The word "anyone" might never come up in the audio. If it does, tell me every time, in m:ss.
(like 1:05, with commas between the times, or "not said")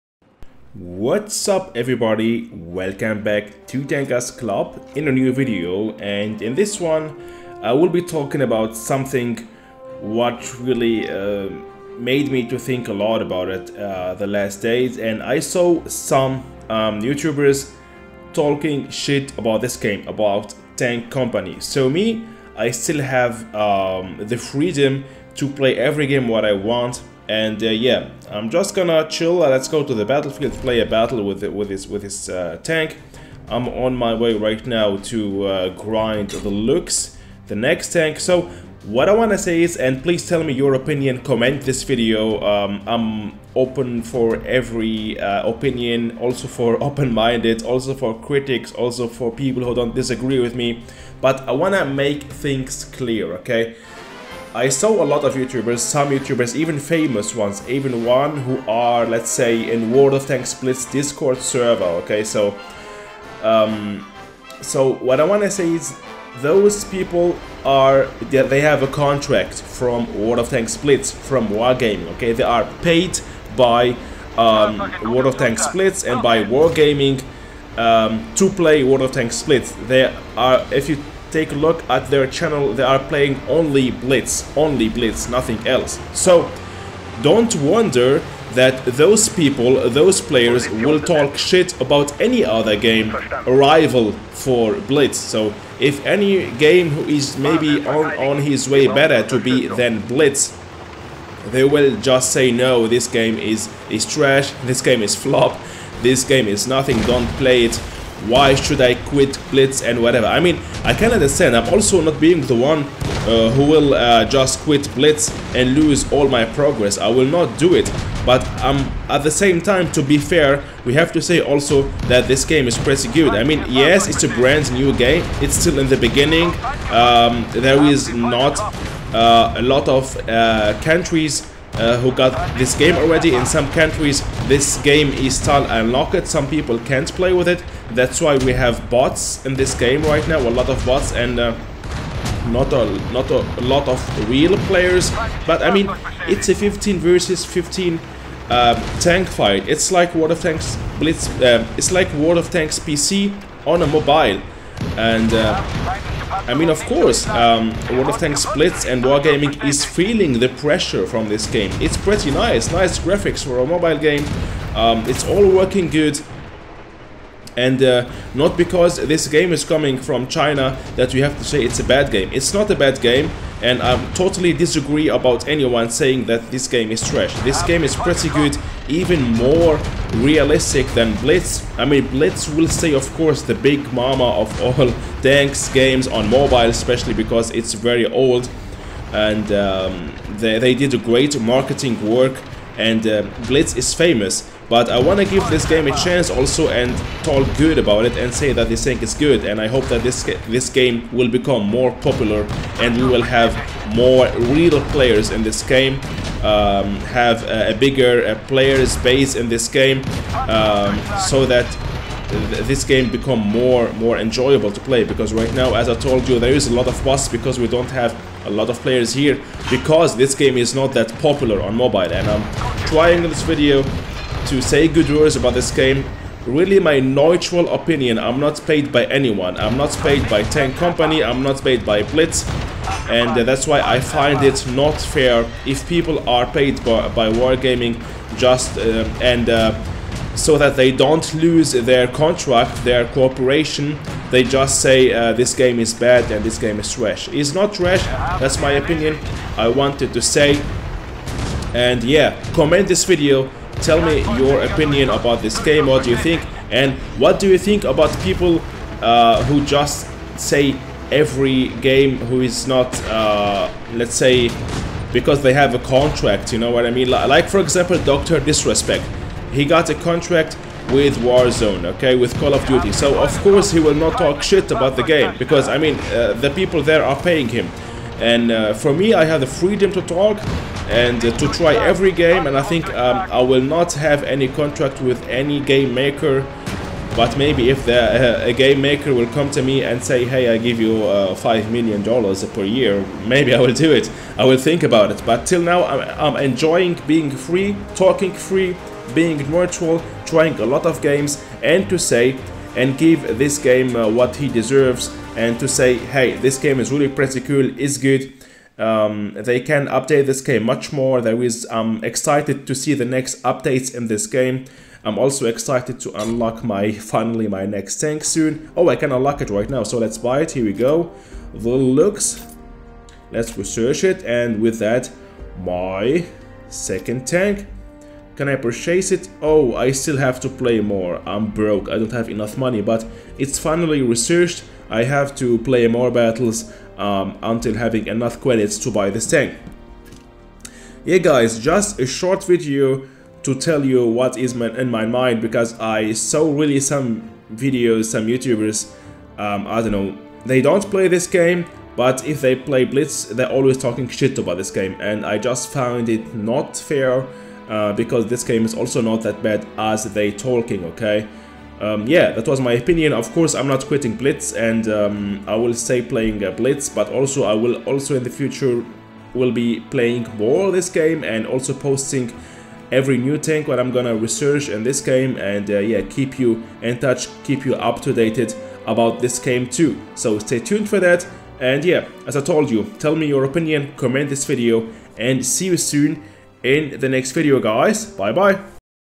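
2:55, 3:49.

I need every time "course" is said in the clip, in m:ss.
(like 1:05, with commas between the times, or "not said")
2:36, 3:03, 4:33, 6:03.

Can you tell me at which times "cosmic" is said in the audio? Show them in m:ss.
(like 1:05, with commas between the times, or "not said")
not said.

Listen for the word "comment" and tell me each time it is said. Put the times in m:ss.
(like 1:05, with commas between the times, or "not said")
0:41, 4:12, 6:23.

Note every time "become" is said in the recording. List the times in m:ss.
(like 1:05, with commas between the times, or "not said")
3:21, 3:33.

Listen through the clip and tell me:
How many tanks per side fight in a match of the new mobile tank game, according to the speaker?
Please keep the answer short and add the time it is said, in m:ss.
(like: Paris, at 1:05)
15, at 2:26.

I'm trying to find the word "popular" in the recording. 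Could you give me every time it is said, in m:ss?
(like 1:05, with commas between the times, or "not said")
3:21, 3:41.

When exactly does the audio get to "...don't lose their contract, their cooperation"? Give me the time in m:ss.
4:00.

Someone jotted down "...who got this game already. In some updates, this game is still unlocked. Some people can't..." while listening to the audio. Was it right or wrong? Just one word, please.
wrong.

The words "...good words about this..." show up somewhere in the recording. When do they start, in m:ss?
3:44.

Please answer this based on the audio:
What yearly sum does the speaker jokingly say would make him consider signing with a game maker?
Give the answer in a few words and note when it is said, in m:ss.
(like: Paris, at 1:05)
5 million dollars, at 4:51.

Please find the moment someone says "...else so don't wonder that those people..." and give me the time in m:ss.
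1:25.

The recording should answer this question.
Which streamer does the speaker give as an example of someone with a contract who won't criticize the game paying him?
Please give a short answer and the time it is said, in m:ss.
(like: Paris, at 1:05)
Dr. Disrespect, at 4:28.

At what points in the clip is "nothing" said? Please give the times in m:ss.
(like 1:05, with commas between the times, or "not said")
1:25, 1:46.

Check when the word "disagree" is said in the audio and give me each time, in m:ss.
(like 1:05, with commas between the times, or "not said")
0:49, 2:54.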